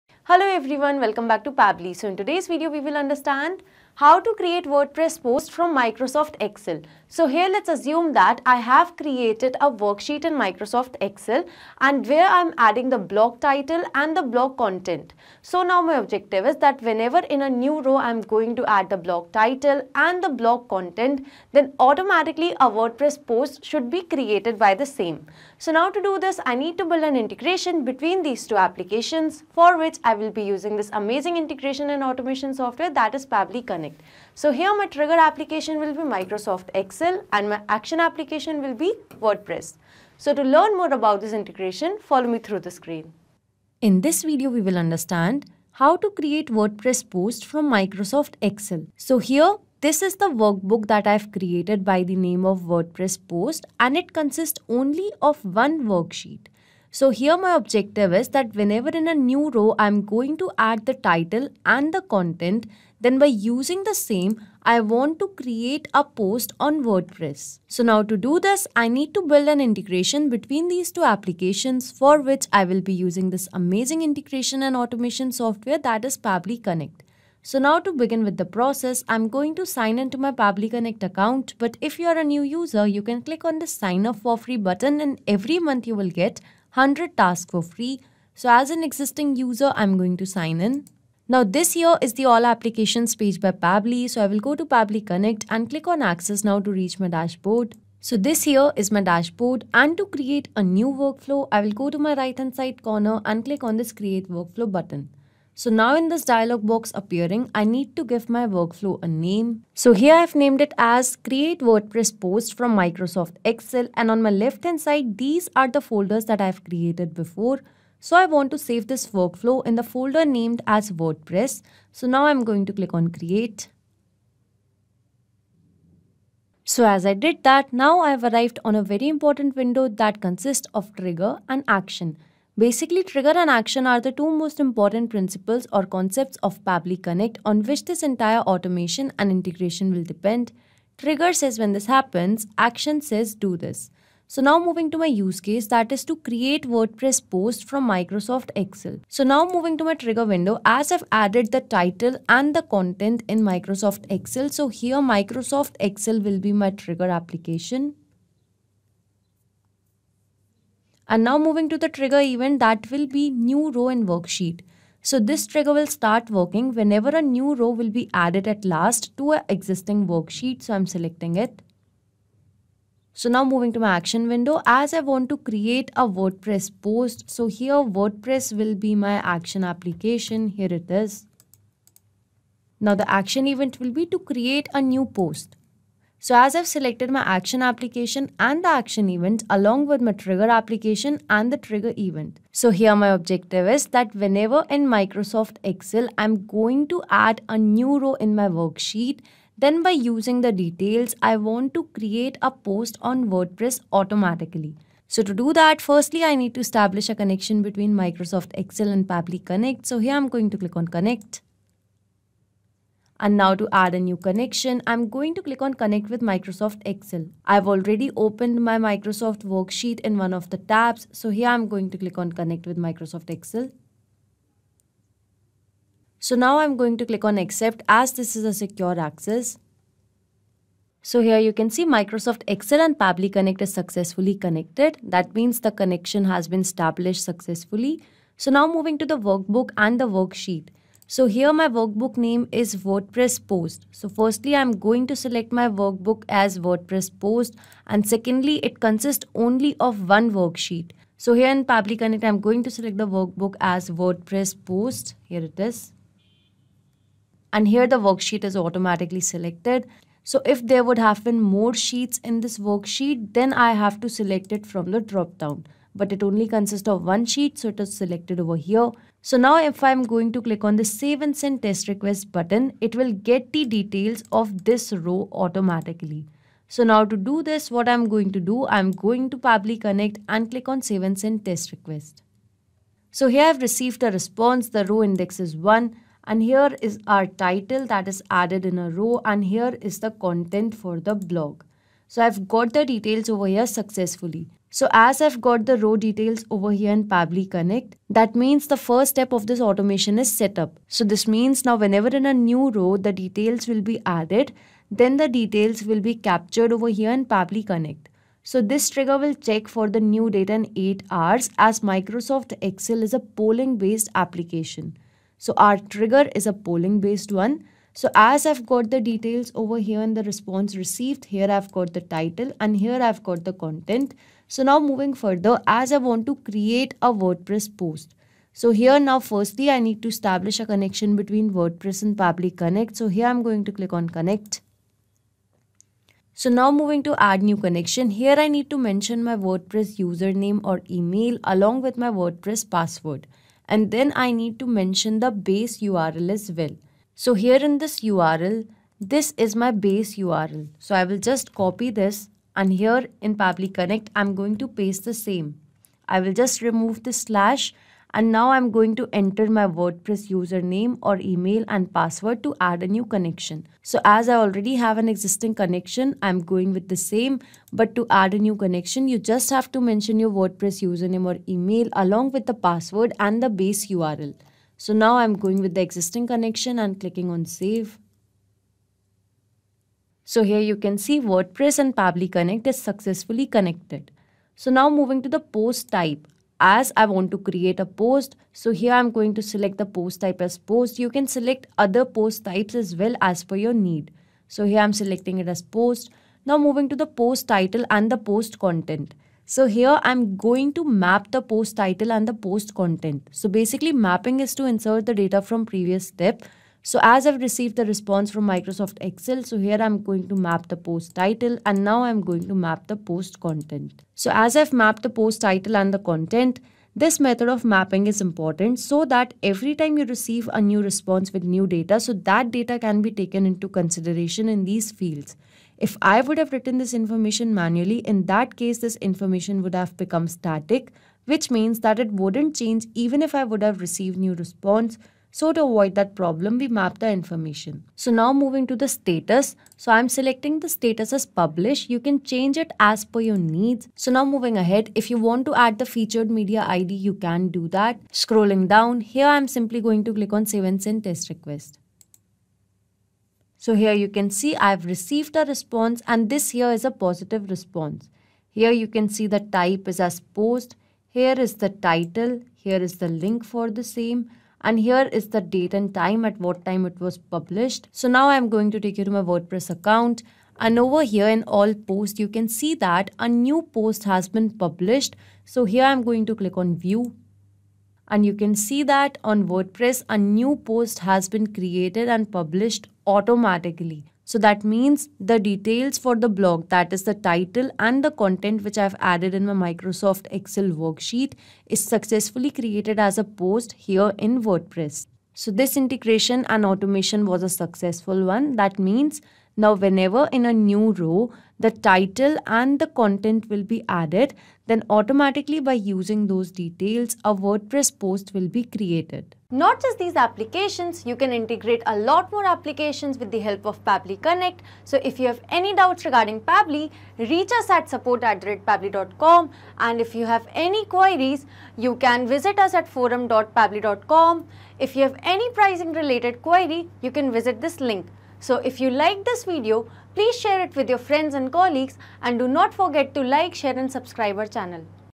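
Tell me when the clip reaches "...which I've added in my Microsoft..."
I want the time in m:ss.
8:08.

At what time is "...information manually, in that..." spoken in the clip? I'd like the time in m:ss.
7:06.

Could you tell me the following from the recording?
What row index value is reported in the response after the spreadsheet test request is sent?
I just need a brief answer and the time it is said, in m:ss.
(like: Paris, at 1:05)
1, at 4:44.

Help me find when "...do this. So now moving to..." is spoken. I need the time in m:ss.
2:23.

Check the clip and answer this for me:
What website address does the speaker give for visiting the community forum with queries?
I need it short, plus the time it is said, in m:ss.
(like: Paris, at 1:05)
forum.pabbly.com, at 8:42.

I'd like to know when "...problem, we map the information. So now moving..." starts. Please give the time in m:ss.
7:16.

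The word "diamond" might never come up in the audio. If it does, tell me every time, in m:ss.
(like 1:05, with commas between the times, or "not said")
not said.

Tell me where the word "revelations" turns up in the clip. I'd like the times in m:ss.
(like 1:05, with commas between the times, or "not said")
not said.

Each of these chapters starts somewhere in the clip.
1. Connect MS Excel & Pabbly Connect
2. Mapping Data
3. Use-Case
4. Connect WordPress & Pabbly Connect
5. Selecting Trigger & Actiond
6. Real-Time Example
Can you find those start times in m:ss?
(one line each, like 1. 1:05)
1. 3:28
2. 6:38
3. 0:49
4. 5:31
5. 2:31
6. 7:50.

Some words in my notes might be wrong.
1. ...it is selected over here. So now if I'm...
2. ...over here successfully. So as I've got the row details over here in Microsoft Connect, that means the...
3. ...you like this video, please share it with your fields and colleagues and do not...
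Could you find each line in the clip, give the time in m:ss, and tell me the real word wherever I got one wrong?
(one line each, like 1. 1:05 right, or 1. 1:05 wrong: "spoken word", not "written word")
1. 4:27 right
2. 4:53 wrong: "Pabbly", not "Microsoft"
3. 8:48 wrong: "friends", not "fields".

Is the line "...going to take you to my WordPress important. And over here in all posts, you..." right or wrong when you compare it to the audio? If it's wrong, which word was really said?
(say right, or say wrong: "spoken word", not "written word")
wrong: "account", not "important".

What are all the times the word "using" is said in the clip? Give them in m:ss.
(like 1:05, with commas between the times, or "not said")
0:30, 1:03, 1:12, 3:20, 8:25.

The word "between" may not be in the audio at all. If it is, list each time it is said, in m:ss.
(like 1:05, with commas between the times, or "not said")
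0:27, 1:10, 3:27, 5:31.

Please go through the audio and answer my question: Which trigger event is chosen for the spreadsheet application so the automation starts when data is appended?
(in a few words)
New row in worksheet.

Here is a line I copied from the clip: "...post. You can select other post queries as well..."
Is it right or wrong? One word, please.
wrong.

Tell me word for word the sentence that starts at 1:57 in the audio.
So I want to save this workflow in the folder named as WordPress.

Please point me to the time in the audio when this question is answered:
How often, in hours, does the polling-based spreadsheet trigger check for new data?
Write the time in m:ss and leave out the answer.
5:10.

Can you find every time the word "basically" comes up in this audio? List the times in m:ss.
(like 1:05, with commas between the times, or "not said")
2:12, 6:43.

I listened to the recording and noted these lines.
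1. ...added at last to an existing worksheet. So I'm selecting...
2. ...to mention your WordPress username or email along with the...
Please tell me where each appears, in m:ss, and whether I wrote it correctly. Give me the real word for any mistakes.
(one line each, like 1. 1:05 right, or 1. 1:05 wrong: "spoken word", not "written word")
1. 2:48 right
2. 6:09 right.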